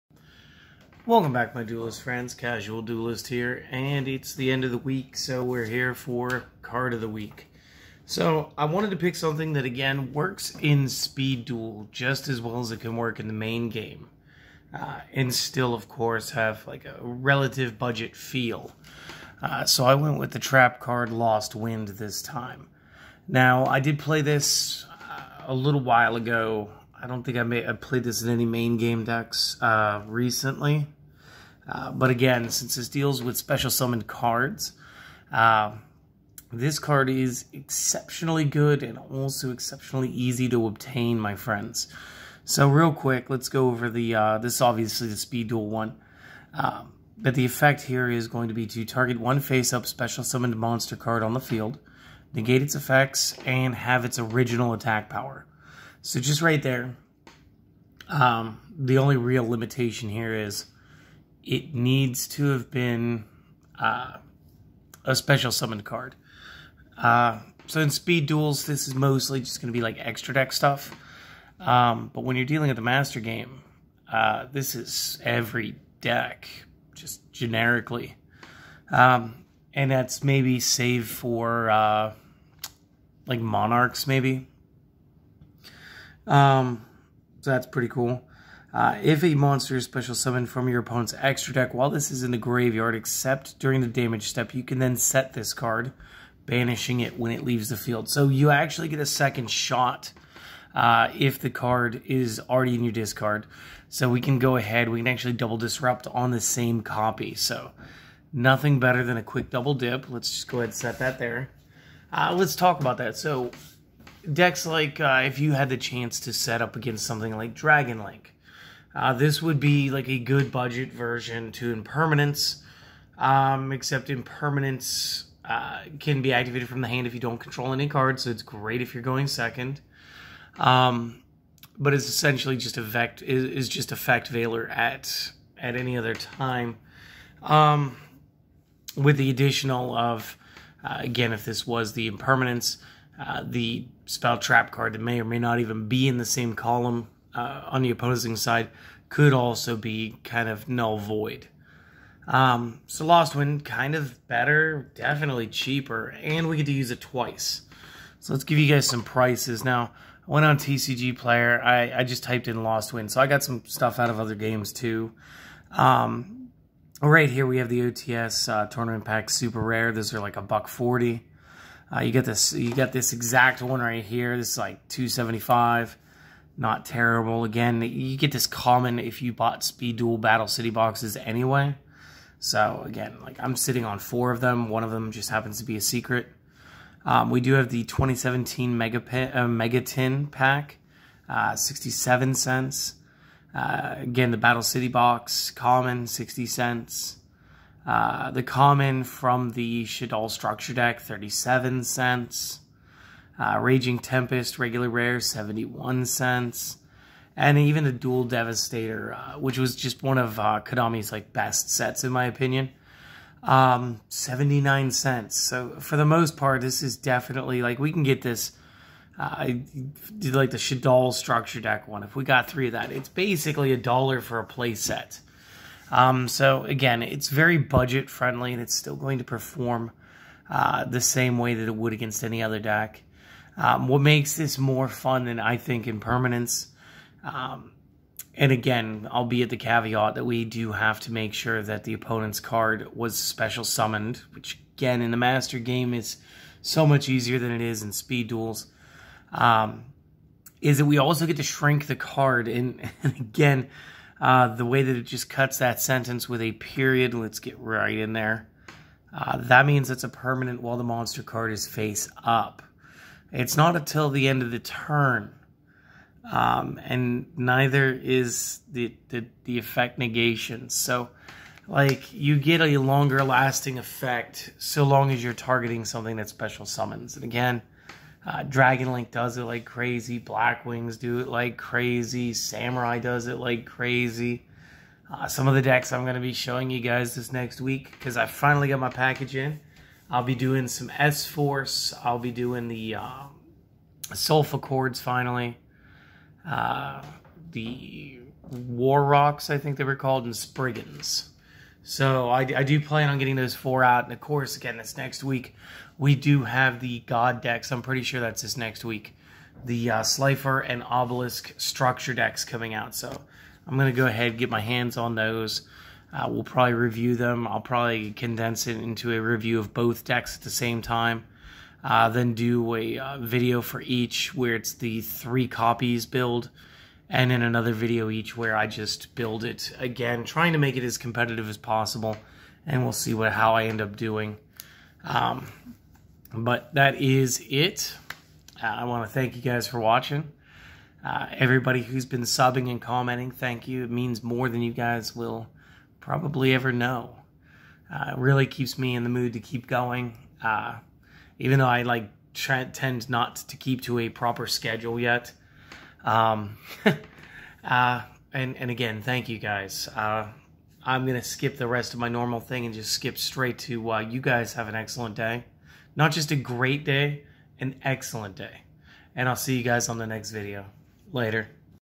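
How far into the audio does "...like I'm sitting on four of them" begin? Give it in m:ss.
3:03.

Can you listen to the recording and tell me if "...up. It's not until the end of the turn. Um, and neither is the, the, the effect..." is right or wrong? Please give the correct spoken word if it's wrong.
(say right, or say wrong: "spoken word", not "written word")
right.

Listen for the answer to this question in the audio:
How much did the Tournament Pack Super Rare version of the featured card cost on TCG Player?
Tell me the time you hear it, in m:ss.
2:50.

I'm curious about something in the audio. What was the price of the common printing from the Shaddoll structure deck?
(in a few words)
37 cents.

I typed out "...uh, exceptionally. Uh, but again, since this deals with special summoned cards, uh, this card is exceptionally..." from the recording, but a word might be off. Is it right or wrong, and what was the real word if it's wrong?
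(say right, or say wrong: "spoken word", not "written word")
wrong: "recently", not "exceptionally".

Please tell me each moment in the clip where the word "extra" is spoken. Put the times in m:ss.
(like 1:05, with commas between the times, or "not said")
1:09, 1:31.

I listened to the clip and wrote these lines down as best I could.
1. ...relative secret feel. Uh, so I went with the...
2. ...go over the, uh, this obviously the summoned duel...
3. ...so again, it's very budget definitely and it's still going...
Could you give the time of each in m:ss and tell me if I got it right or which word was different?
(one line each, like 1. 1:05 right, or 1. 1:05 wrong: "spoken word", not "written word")
1. 0:17 wrong: "budget", not "secret"
2. 0:43 wrong: "speed", not "summoned"
3. 3:46 wrong: "friendly", not "definitely".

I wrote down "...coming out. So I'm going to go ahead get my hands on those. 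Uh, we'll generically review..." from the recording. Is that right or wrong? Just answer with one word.
wrong.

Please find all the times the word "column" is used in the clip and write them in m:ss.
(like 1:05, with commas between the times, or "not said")
2:26.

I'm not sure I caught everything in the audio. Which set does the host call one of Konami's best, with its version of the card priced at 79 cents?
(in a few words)
Duel Devastator.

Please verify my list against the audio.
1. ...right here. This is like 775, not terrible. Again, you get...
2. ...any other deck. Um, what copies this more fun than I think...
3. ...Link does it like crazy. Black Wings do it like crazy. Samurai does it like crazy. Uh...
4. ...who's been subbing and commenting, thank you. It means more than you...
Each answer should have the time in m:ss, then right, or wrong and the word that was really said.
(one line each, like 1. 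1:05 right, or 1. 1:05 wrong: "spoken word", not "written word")
1. 2:53 wrong: "275", not "775"
2. 3:52 wrong: "makes", not "copies"
3. 4:38 right
4. 5:41 right.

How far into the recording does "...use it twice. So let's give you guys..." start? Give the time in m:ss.
2:36.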